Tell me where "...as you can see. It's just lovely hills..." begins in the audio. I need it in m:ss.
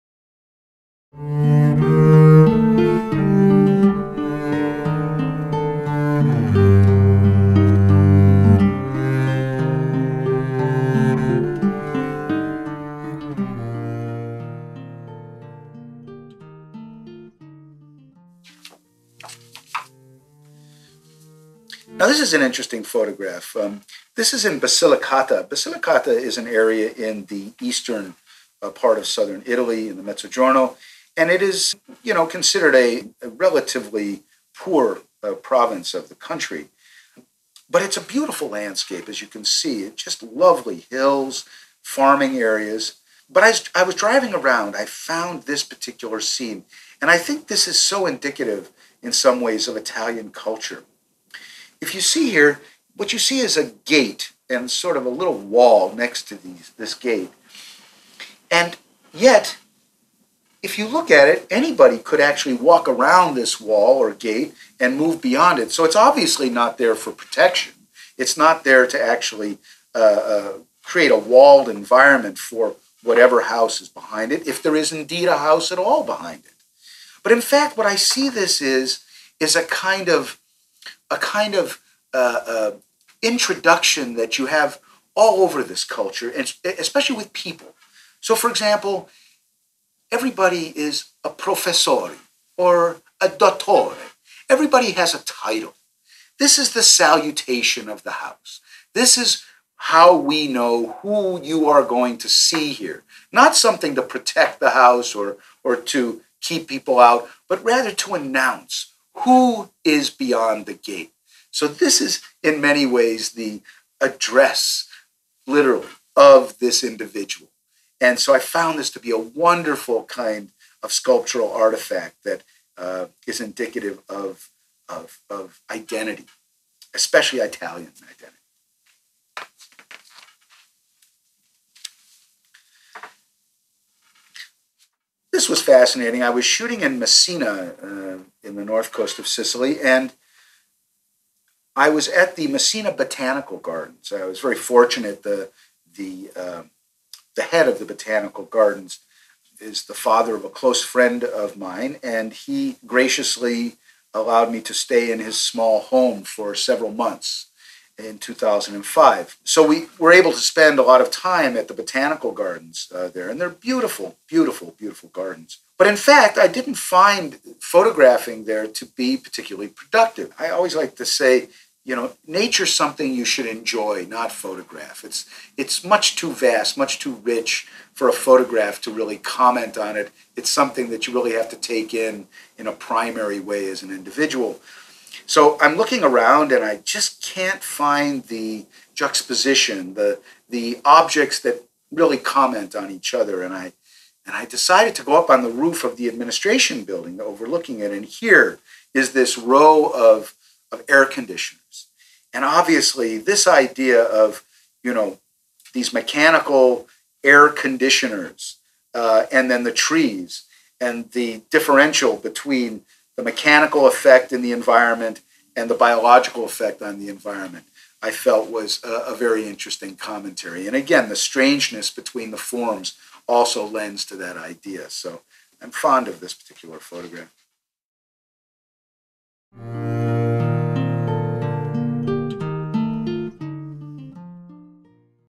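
0:39.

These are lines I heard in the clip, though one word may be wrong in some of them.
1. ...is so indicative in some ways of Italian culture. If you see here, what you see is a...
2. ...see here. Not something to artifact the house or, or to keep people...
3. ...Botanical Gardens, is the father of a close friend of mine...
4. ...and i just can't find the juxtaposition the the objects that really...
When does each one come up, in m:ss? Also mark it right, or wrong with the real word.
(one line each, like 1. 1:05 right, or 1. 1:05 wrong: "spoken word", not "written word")
1. 0:47 right
2. 1:42 wrong: "protect", not "artifact"
3. 2:27 right
4. 3:06 right.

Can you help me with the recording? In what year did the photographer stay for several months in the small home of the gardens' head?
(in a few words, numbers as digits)
2005.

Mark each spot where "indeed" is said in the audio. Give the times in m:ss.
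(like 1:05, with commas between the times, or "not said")
1:14.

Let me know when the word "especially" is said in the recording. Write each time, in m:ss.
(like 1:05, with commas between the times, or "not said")
1:26, 2:06.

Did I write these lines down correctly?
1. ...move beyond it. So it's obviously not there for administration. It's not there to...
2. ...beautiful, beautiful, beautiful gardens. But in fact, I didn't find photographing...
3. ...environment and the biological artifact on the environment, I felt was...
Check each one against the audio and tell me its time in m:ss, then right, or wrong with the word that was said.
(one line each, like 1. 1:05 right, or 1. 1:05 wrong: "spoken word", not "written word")
1. 1:04 wrong: "protection", not "administration"
2. 2:43 right
3. 3:34 wrong: "effect", not "artifact".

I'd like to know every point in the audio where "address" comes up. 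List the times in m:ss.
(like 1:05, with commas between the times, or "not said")
1:53.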